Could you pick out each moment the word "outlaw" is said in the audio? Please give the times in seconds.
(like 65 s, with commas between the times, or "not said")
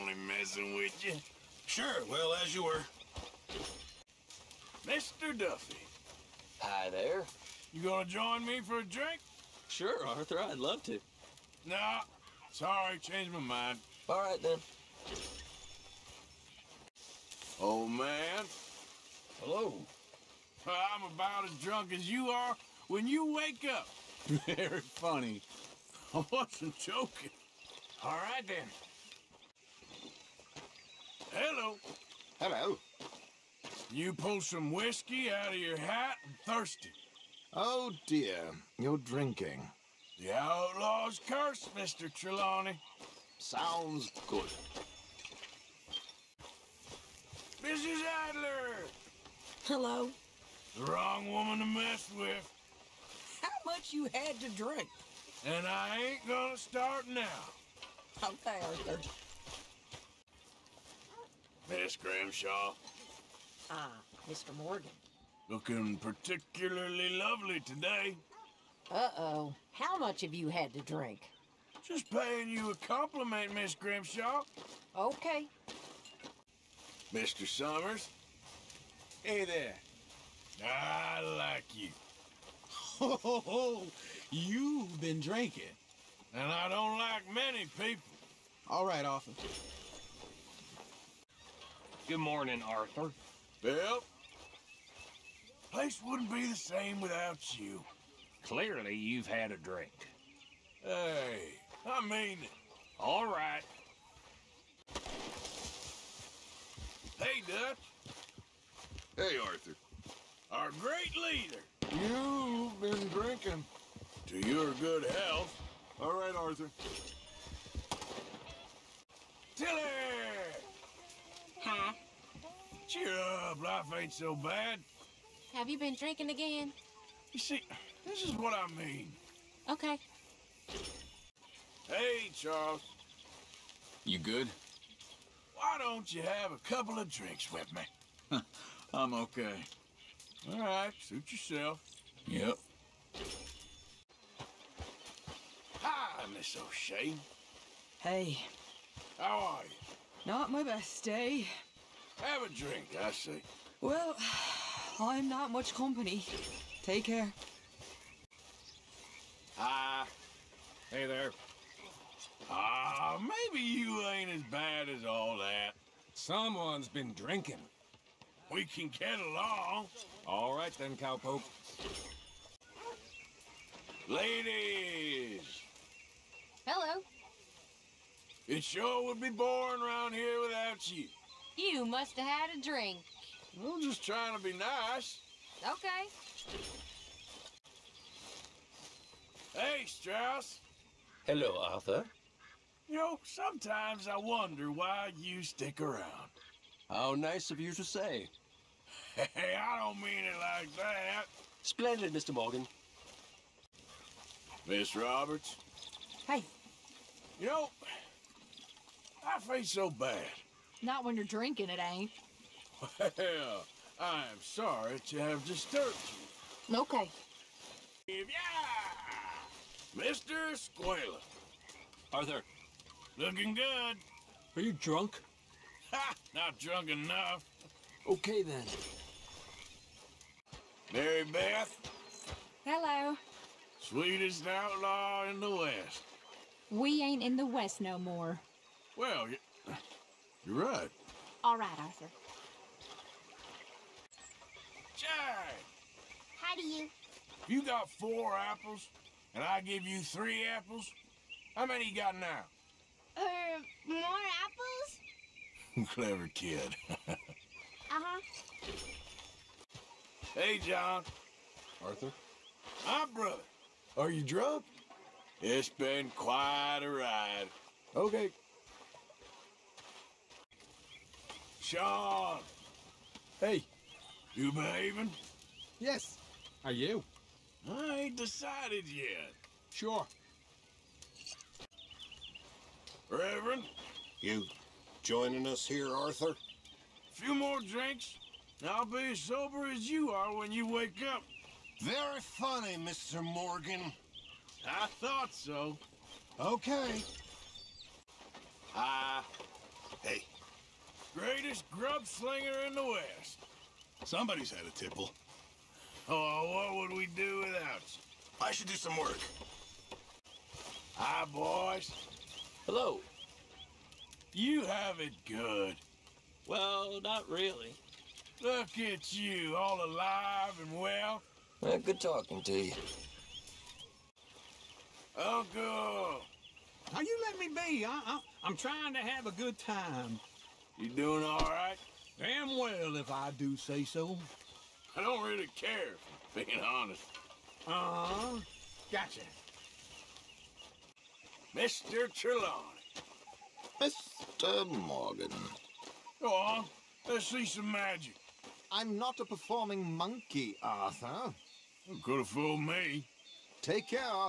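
40 s, 234 s.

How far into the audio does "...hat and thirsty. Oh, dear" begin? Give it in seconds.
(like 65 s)
35 s.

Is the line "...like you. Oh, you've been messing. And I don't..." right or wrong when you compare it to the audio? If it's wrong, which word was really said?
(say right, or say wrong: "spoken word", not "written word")
wrong: "drinking", not "messing".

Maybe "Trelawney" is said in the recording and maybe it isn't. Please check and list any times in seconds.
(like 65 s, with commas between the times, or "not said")
42 s, 342 s.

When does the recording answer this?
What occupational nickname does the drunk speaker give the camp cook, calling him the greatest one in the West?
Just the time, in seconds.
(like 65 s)
301 s.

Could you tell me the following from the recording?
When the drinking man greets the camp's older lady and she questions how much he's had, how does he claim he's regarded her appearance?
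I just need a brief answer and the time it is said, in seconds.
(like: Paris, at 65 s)
particularly lovely, at 65 s.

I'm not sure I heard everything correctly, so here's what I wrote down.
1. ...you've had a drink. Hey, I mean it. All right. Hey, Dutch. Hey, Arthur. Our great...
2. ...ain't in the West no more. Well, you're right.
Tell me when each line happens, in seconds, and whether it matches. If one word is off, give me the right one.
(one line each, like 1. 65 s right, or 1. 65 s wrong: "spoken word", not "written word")
1. 98 s right
2. 237 s right.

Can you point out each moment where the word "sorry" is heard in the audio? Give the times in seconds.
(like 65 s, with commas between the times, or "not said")
12 s, 214 s.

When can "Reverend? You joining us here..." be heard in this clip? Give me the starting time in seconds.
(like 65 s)
283 s.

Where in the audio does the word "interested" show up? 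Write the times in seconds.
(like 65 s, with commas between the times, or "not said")
not said.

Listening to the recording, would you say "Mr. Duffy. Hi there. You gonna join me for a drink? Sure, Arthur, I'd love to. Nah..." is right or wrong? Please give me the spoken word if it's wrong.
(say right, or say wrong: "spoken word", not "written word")
right.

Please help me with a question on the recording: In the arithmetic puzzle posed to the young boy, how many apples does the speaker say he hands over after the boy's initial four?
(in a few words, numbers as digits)
3.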